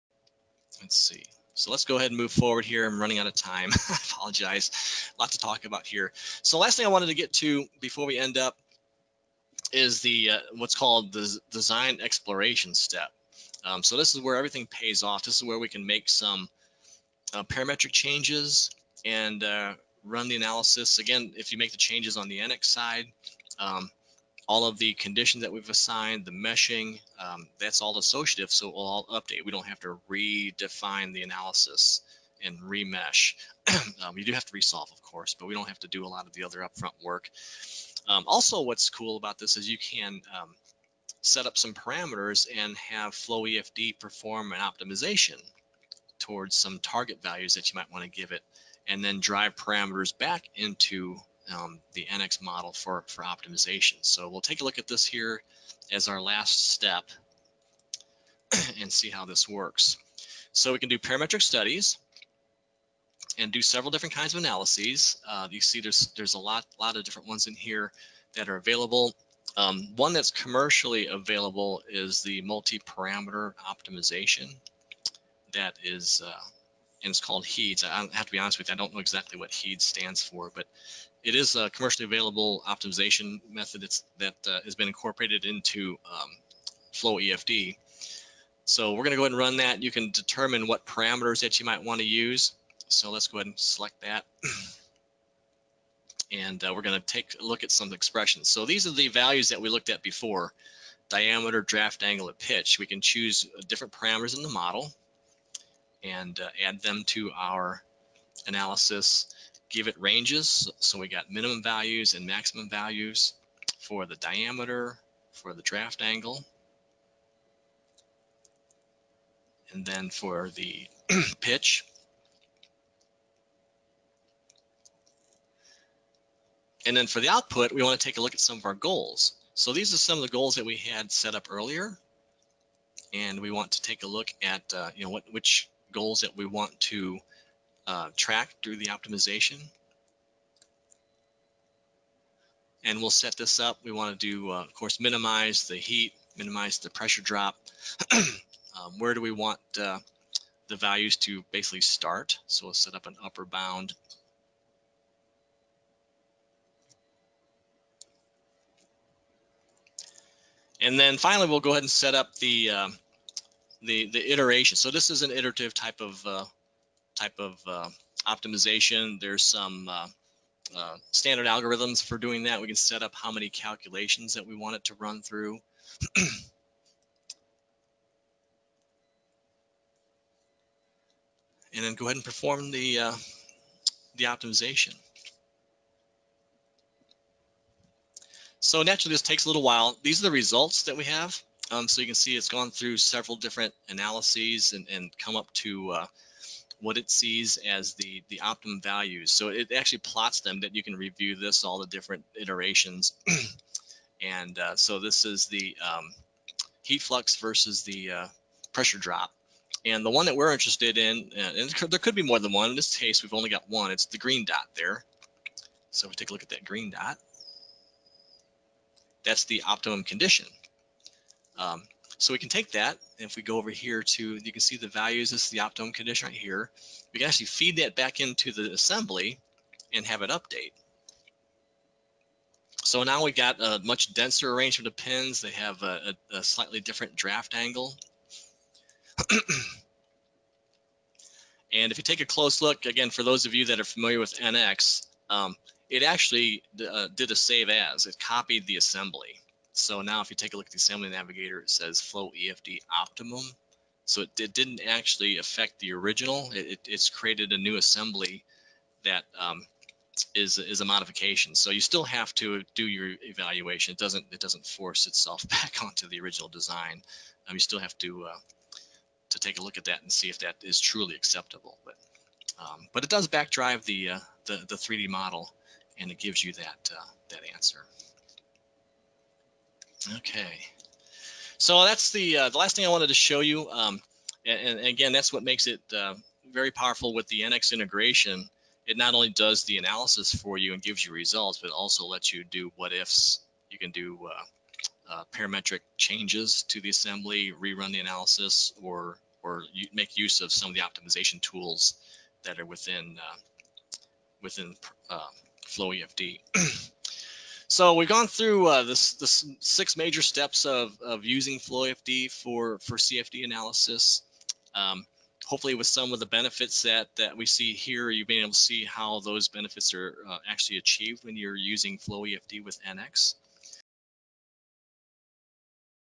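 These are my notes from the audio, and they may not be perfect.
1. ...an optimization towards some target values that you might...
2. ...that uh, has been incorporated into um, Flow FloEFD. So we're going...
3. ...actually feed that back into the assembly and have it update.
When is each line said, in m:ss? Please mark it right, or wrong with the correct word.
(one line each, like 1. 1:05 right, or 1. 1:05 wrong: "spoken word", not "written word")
1. 0:44 right
2. 1:24 wrong: "EFD", not "FloEFD"
3. 3:47 right.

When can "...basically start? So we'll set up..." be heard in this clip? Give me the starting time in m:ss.
2:31.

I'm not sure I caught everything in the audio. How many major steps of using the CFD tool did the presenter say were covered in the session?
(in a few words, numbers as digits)
6.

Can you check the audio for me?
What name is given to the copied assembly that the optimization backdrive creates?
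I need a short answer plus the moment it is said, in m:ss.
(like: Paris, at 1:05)
FloEFD optimum, at 4:12.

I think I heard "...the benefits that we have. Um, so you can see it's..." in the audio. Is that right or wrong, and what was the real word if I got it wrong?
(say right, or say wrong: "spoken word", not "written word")
wrong: "results", not "benefits".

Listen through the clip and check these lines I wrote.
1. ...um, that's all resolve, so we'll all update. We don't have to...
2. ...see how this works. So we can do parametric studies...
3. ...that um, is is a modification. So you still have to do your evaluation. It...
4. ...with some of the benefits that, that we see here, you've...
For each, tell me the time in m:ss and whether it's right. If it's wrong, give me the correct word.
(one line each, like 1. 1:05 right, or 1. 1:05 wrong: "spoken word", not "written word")
1. 0:27 wrong: "associative", not "resolve"
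2. 0:58 right
3. 4:19 right
4. 5:15 right.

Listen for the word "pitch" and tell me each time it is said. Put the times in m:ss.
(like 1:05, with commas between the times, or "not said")
1:42, 2:01.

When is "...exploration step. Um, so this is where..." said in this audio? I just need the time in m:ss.
0:12.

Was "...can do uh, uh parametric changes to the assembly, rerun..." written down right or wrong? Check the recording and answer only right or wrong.
right.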